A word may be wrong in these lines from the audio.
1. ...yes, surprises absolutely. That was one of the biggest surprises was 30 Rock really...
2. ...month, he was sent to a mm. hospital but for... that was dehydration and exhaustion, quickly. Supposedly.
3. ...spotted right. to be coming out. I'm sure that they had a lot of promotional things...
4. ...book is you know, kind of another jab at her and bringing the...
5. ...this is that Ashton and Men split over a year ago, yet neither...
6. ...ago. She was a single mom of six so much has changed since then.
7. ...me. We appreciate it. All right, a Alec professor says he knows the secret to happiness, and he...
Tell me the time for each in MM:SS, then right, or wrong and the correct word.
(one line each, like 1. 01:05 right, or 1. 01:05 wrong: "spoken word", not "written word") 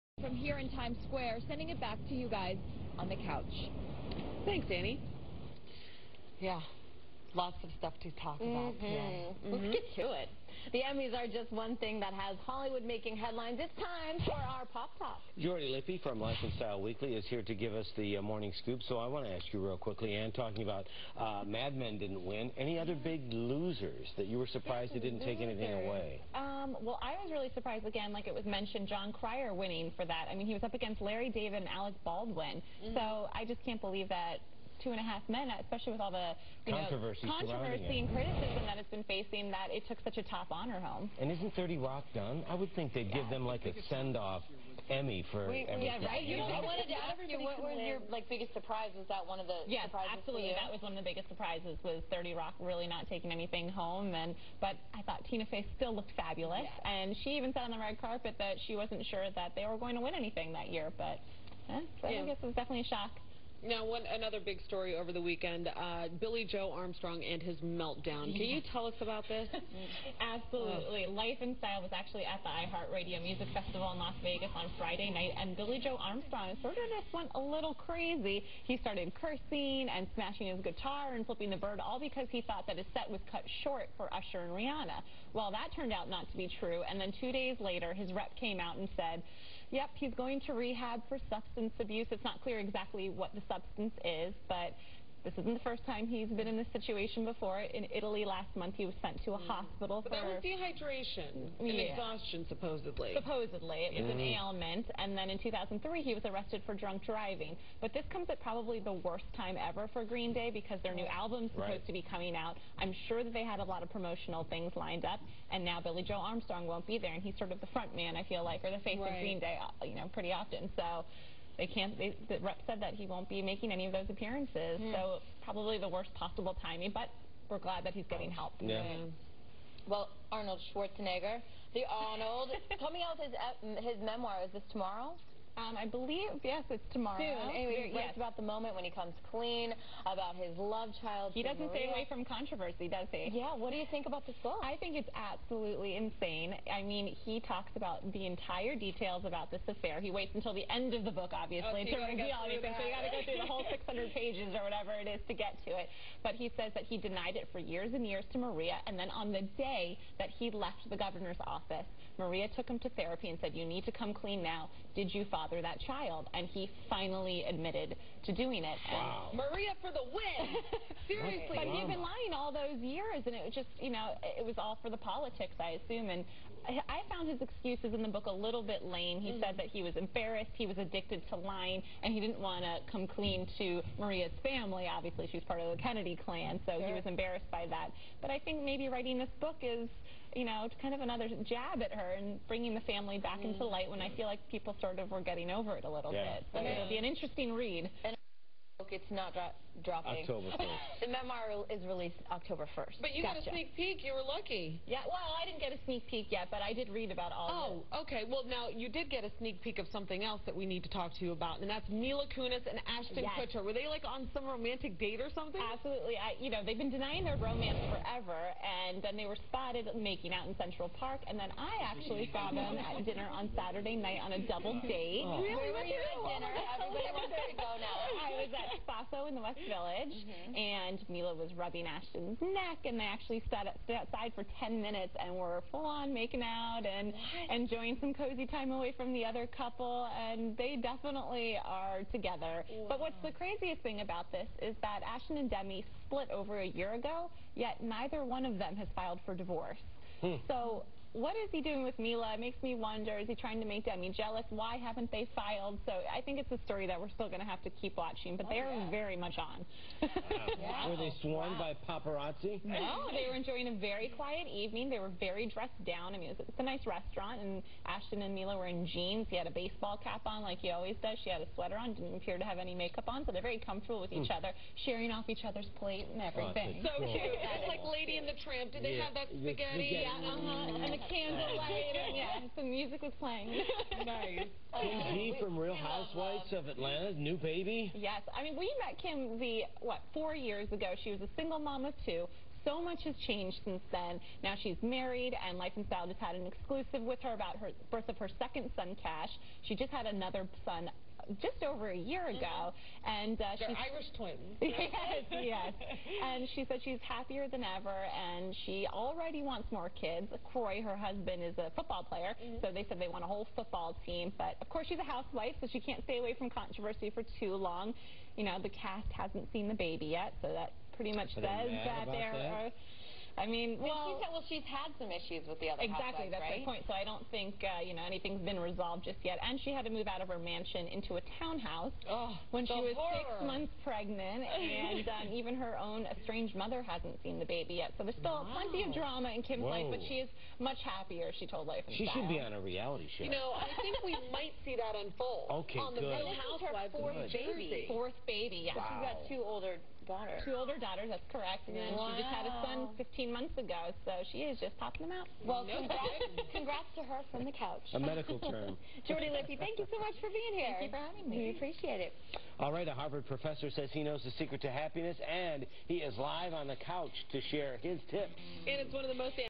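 1. 00:49 right
2. 01:38 wrong: "supposedly", not "quickly"
3. 01:51 wrong: "supposed", not "spotted"
4. 03:09 right
5. 04:04 wrong: "Demi", not "Men"
6. 04:50 wrong: "two", not "six"
7. 06:01 wrong: "Harvard", not "Alec".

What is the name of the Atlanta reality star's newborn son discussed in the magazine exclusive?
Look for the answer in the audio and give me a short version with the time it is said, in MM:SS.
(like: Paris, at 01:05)
Cash, at 04:59.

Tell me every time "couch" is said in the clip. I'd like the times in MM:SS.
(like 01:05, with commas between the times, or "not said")
00:03, 05:57, 06:06.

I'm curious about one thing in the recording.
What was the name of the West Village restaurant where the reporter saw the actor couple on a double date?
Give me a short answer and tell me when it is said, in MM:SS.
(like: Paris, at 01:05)
Spasso, at 03:48.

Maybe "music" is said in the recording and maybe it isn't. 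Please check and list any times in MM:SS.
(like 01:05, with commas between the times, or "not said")
01:13, 04:42.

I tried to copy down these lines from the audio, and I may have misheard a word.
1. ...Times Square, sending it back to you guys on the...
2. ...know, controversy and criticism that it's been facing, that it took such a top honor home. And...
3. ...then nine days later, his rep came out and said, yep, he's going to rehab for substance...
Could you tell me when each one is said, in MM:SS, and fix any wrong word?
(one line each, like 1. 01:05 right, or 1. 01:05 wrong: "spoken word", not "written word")
1. 00:00 right
2. 00:37 right
3. 01:26 wrong: "two", not "nine".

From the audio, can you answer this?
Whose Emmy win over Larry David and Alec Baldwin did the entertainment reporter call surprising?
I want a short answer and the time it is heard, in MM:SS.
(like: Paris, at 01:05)
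Jon Cryer, at 00:28.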